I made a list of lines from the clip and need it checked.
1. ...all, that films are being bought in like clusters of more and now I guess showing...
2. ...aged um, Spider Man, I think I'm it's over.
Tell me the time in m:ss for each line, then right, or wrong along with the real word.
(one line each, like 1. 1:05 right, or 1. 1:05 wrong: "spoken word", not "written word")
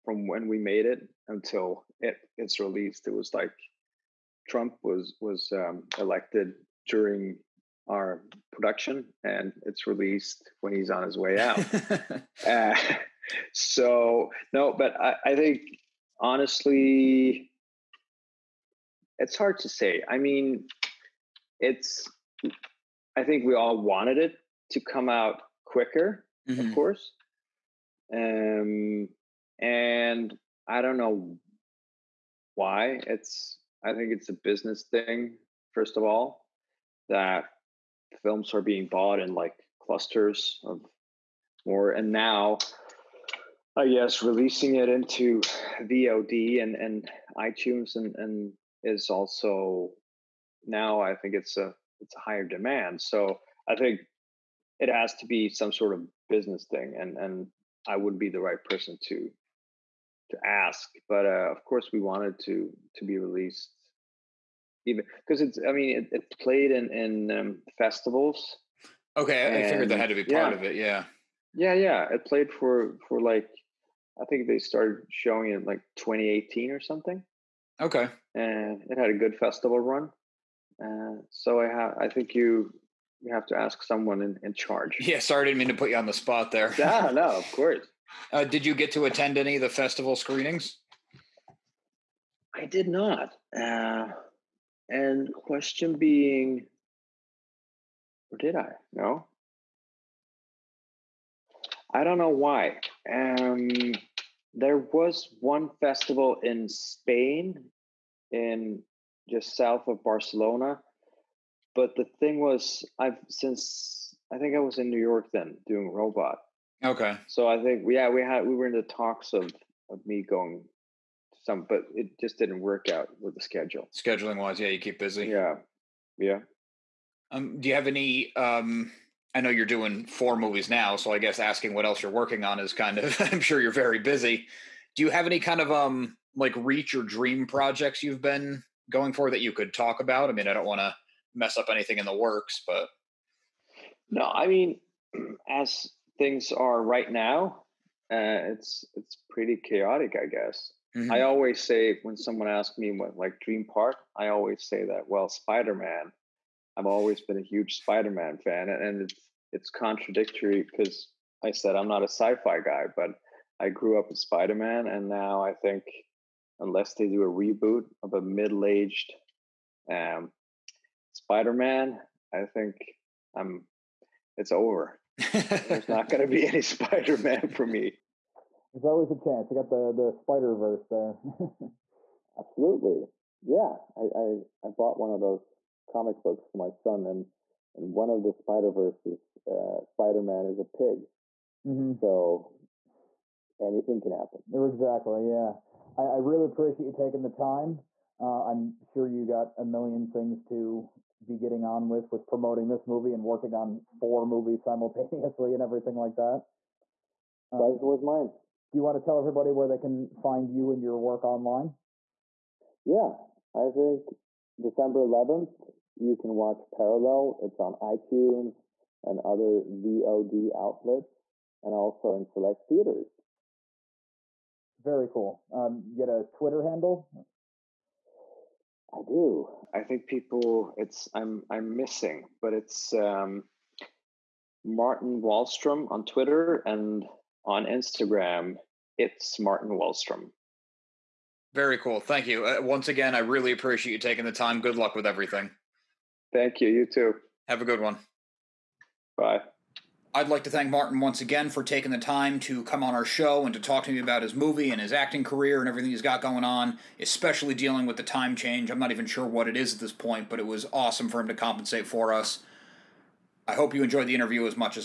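1. 0:36 wrong: "releasing", not "showing"
2. 2:48 right.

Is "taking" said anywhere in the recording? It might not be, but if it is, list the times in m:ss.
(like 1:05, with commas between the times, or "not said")
3:16, 4:03, 4:11.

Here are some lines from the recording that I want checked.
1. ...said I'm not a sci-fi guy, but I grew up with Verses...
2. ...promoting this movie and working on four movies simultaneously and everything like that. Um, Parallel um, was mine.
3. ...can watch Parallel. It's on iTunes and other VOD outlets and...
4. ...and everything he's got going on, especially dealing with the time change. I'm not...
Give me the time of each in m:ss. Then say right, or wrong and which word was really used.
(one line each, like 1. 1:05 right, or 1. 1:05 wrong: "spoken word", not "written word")
1. 2:41 wrong: "Spider", not "Verses"
2. 3:22 wrong: "Pleasure", not "Parallel"
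3. 3:36 right
4. 4:15 right.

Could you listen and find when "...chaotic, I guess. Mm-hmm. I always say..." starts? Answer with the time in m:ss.
2:29.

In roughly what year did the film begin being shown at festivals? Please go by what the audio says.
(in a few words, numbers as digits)
2018.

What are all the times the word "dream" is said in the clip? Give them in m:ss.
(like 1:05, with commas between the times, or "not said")
2:17, 2:33.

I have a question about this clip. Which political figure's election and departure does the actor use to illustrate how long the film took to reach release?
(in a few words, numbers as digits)
Trump.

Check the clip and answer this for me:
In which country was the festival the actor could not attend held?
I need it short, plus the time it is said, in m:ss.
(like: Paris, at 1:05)
Spain, at 1:46.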